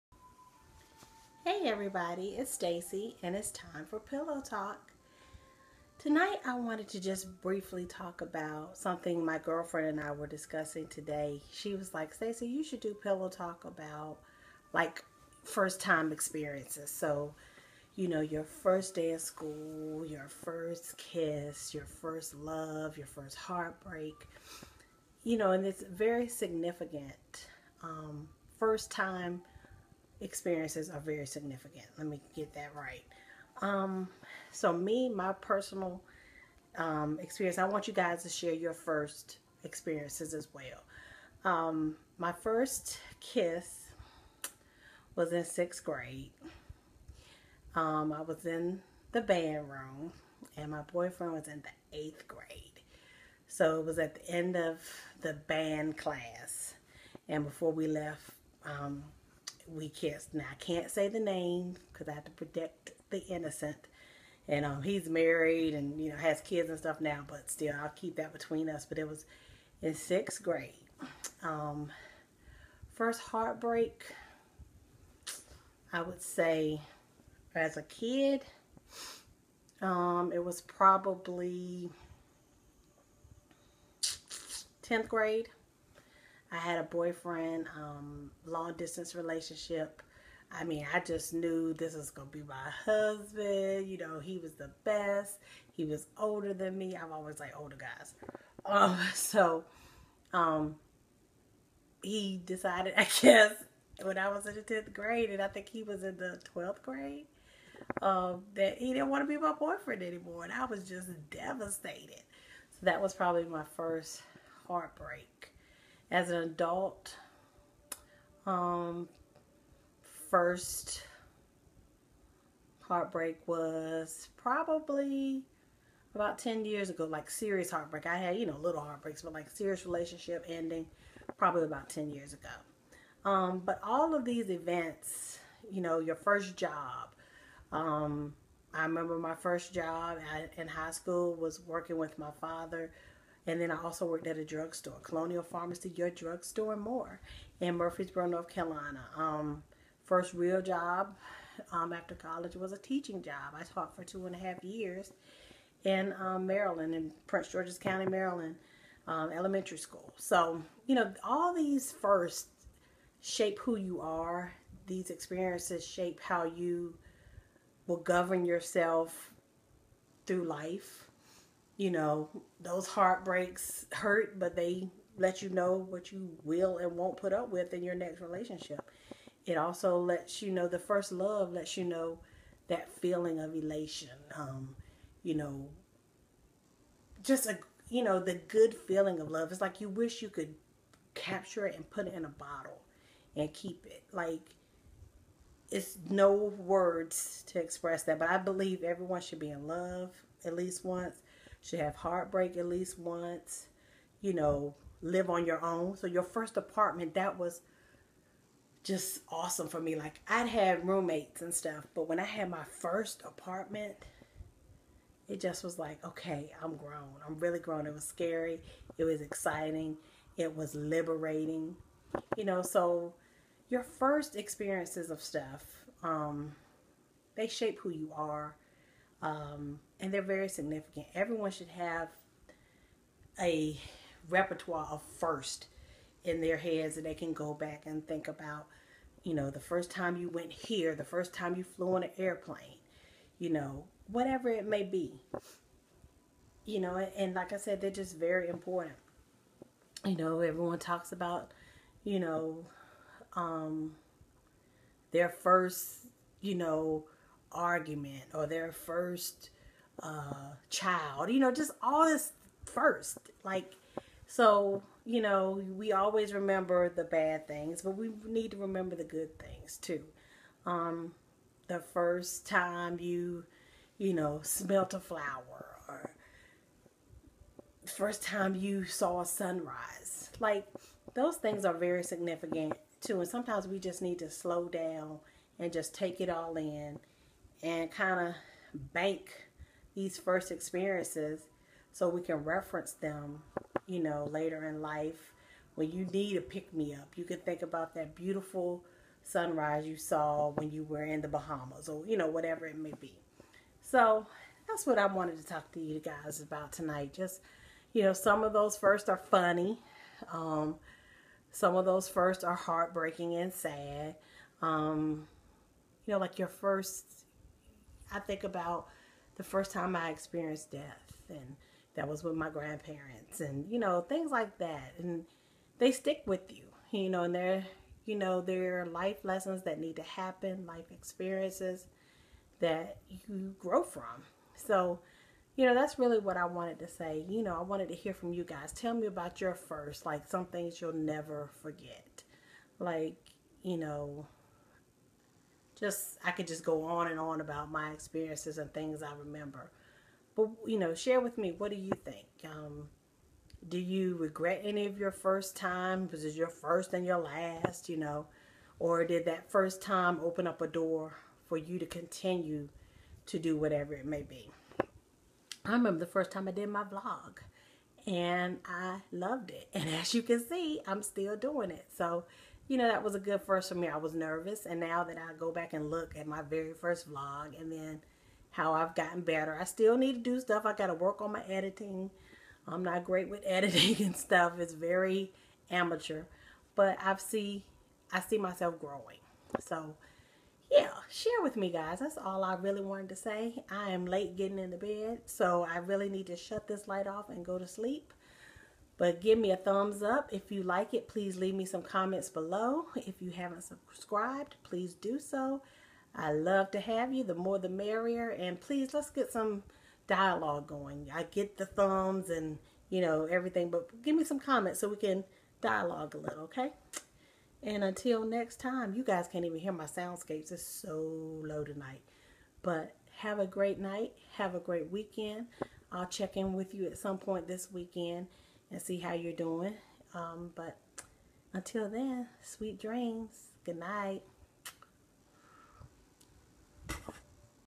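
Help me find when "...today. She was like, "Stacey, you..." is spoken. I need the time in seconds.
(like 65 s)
10 s.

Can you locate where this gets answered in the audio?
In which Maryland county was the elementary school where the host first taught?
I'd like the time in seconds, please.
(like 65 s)
157 s.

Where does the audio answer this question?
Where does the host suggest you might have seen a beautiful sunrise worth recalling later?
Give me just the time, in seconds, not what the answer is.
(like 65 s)
301 s.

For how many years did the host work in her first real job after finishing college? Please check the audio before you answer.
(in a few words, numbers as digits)
2.5.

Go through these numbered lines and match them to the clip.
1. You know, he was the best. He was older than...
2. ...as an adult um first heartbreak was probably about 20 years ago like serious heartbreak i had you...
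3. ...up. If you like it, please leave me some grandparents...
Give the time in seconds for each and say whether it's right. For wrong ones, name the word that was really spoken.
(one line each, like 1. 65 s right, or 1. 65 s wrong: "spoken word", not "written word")
1. 93 s right
2. 116 s wrong: "10", not "20"
3. 400 s wrong: "comments", not "grandparents".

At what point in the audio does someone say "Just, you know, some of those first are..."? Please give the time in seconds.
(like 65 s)
307 s.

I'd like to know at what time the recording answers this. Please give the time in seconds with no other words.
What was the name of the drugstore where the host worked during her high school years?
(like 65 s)
145 s.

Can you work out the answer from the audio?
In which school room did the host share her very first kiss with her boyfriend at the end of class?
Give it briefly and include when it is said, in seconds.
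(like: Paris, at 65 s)
band room, at 49 s.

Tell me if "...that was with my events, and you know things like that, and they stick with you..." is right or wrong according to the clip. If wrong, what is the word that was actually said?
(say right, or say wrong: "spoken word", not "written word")
wrong: "grandparents", not "events".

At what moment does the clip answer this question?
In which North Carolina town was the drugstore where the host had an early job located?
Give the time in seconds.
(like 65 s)
147 s.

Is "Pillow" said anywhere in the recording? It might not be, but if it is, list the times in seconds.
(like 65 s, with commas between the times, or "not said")
3 s, 12 s.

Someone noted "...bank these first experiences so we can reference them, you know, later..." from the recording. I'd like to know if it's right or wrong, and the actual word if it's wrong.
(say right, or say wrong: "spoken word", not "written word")
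right.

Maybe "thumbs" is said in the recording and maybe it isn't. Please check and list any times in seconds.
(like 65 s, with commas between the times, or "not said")
399 s, 411 s.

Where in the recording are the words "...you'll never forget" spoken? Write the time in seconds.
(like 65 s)
340 s.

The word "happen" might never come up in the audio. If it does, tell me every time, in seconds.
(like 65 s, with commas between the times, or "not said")
330 s.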